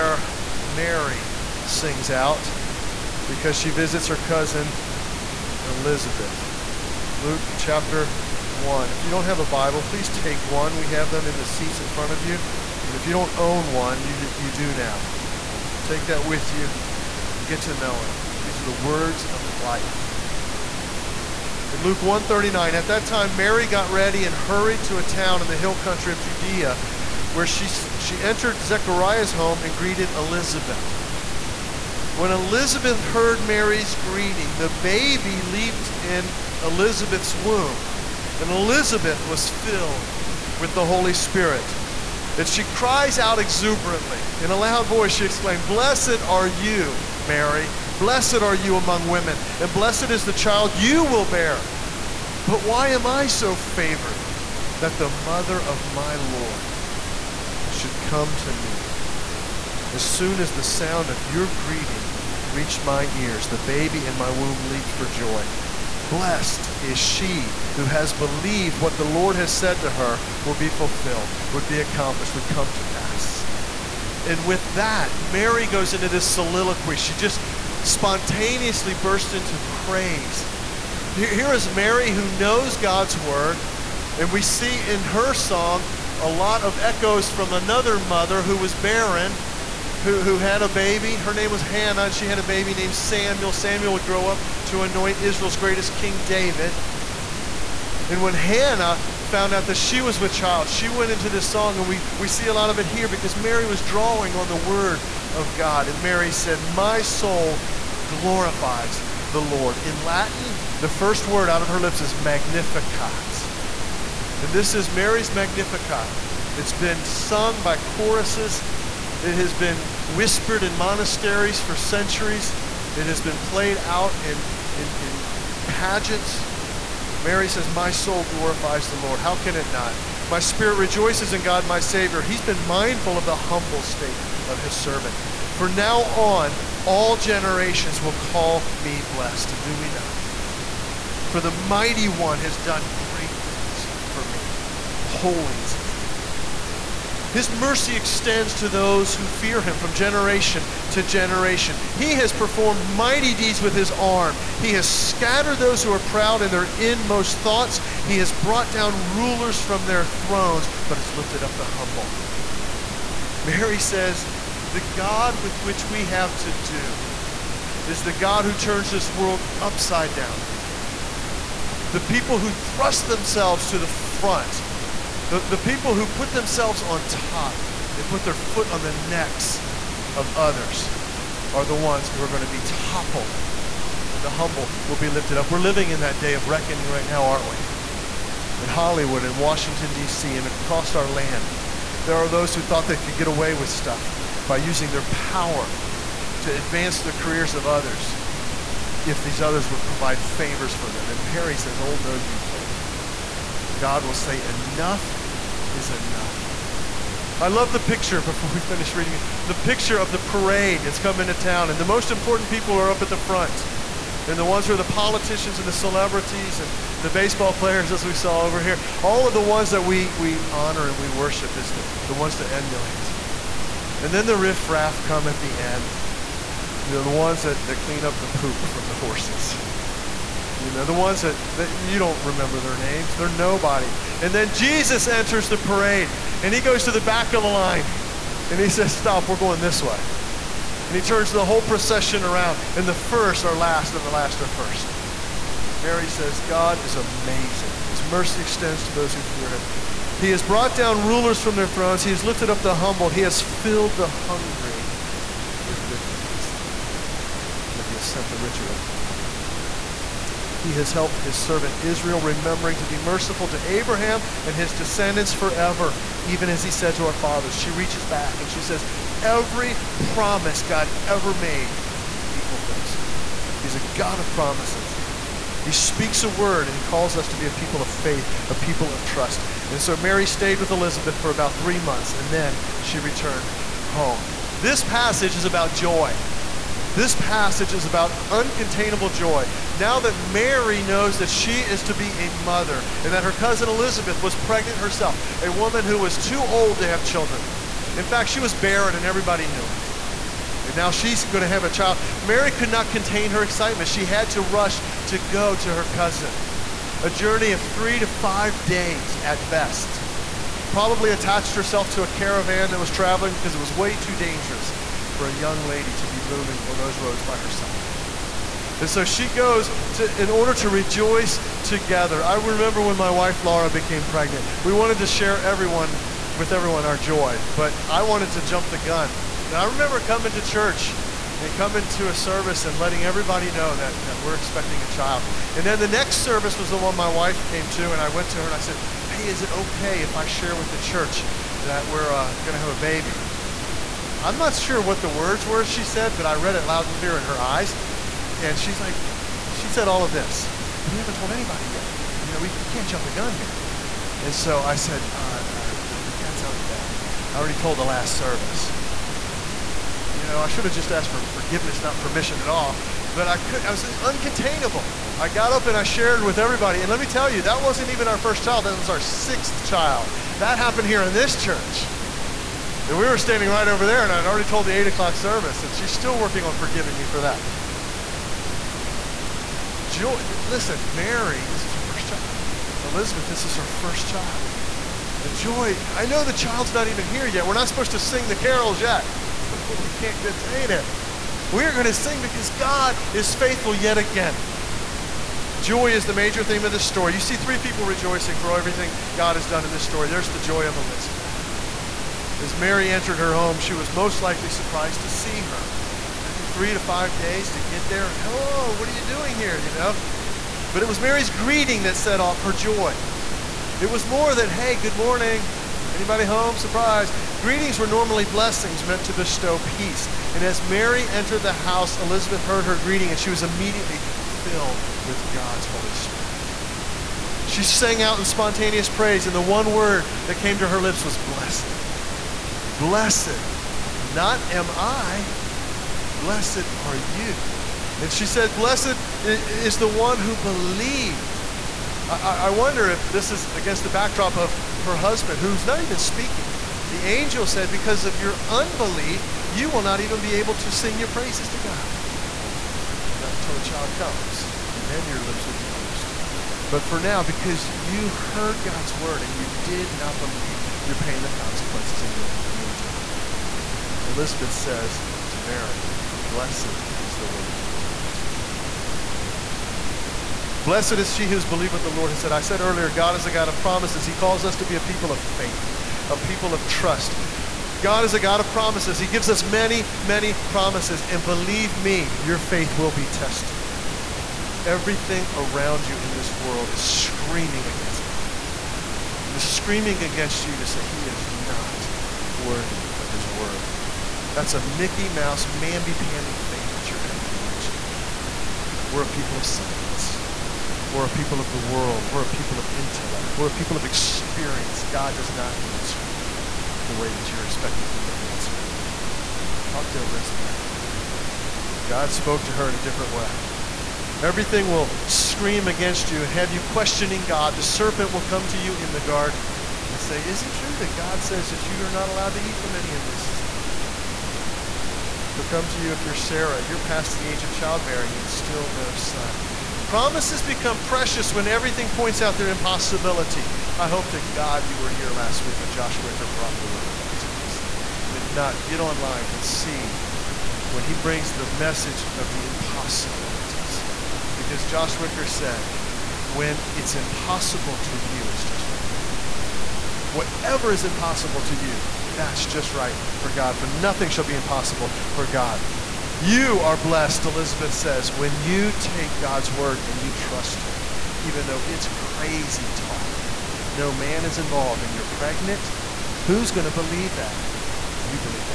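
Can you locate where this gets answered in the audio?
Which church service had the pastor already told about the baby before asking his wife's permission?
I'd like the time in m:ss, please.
6:14.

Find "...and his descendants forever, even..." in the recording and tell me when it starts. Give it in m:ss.
4:24.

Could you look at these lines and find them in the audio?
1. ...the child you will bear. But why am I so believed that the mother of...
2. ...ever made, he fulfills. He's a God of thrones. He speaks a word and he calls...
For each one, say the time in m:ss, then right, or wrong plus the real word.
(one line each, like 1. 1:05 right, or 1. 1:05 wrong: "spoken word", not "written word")
1. 0:50 wrong: "favored", not "believed"
2. 4:31 wrong: "promises", not "thrones".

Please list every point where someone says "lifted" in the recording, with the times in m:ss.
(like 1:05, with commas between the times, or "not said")
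2:41, 3:05, 4:12.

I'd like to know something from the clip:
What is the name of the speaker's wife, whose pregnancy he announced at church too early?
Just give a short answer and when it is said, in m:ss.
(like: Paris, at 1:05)
Laura, at 5:23.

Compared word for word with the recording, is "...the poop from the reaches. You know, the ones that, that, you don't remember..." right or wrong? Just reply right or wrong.
wrong.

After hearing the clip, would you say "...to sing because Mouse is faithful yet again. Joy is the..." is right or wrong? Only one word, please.
wrong.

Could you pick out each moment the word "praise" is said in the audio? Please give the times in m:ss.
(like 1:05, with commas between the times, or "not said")
1:19, 7:08, 7:31.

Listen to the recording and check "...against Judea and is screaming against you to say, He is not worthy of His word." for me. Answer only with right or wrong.
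wrong.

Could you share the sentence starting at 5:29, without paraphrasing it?
And I remember coming to church and coming to a service and letting everybody know that, that we're expecting a child.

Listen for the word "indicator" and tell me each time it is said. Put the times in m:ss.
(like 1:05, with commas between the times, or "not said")
not said.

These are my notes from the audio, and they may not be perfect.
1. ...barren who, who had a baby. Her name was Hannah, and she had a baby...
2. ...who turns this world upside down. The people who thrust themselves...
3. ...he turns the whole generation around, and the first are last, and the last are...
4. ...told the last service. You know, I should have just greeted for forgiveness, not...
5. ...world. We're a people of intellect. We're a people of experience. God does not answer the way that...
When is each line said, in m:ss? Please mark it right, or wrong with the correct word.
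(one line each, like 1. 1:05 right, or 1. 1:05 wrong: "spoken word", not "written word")
1. 1:28 right
2. 2:48 right
3. 4:00 wrong: "procession", not "generation"
4. 5:57 wrong: "asked", not "greeted"
5. 8:21 right.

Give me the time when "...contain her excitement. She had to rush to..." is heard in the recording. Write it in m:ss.
5:02.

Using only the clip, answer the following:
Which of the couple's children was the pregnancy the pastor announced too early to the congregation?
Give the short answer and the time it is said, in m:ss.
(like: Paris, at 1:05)
Sixth child, at 6:08.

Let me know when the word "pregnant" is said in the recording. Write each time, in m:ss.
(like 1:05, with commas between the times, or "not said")
4:54, 5:24, 9:25.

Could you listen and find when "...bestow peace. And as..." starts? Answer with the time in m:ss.
6:59.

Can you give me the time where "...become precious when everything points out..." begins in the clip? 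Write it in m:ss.
8:50.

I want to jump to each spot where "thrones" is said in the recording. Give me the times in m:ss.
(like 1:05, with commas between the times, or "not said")
2:40, 4:11.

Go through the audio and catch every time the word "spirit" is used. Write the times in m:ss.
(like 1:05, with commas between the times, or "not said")
0:41, 2:10, 7:05.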